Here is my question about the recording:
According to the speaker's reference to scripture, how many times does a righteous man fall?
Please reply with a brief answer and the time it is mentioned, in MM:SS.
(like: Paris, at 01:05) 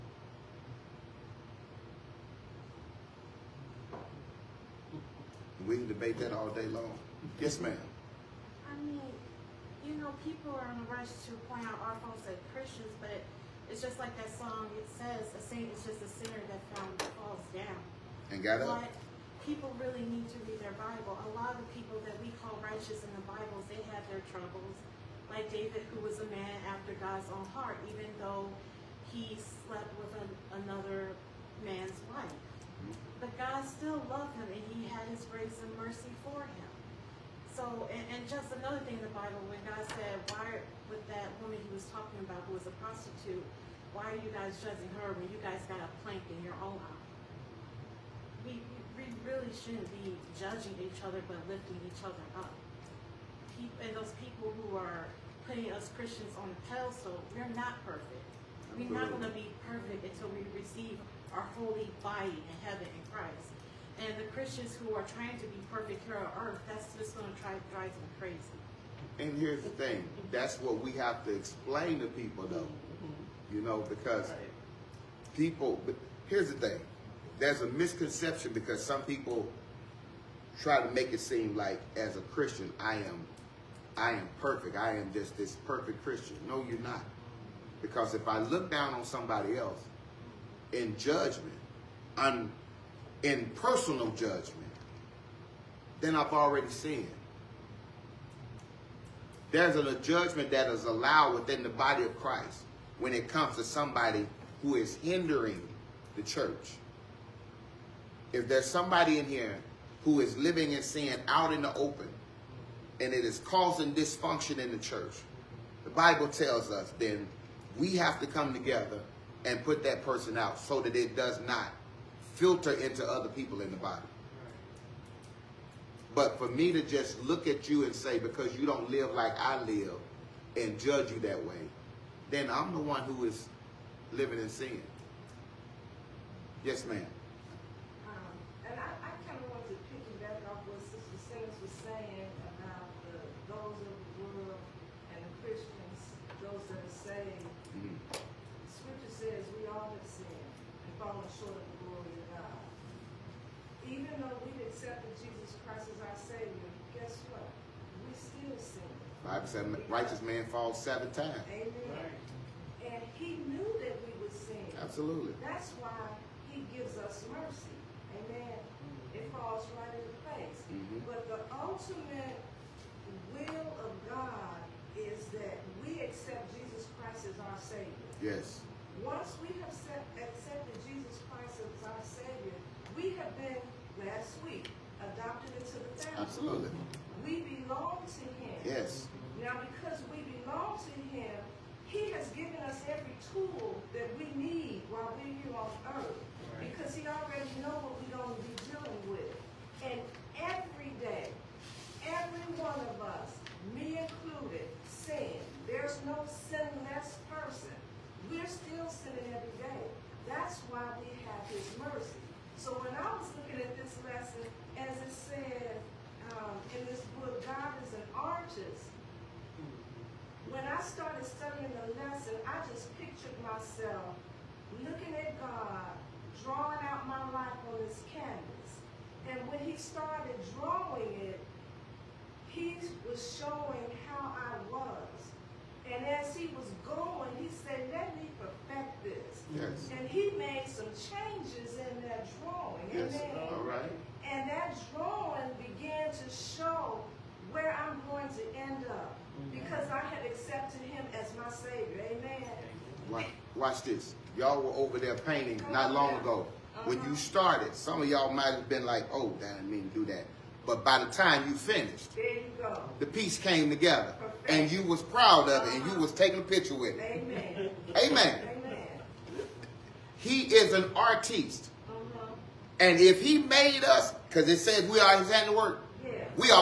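7, at 02:40.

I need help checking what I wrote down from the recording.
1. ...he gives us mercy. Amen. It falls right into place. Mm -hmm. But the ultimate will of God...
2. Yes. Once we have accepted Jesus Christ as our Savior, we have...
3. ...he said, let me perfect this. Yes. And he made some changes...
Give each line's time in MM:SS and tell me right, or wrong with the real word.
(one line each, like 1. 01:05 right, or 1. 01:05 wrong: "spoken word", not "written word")
1. 02:46 right
2. 02:58 right
3. 03:57 right.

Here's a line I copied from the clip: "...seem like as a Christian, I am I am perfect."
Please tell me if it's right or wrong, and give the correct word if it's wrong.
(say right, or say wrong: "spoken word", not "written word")
right.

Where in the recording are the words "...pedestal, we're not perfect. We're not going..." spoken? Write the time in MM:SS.
00:56.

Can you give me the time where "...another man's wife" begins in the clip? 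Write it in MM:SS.
00:30.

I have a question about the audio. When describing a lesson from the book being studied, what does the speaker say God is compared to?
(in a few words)
An artist.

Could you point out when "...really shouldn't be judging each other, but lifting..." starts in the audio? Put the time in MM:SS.
00:49.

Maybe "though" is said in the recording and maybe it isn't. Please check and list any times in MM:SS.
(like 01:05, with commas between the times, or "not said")
00:28, 01:12.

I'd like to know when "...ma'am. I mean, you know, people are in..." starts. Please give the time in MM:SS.
00:07.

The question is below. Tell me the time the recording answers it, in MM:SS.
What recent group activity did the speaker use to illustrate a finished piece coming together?
04:15.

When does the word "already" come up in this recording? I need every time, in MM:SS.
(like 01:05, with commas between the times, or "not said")
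01:36, 03:17.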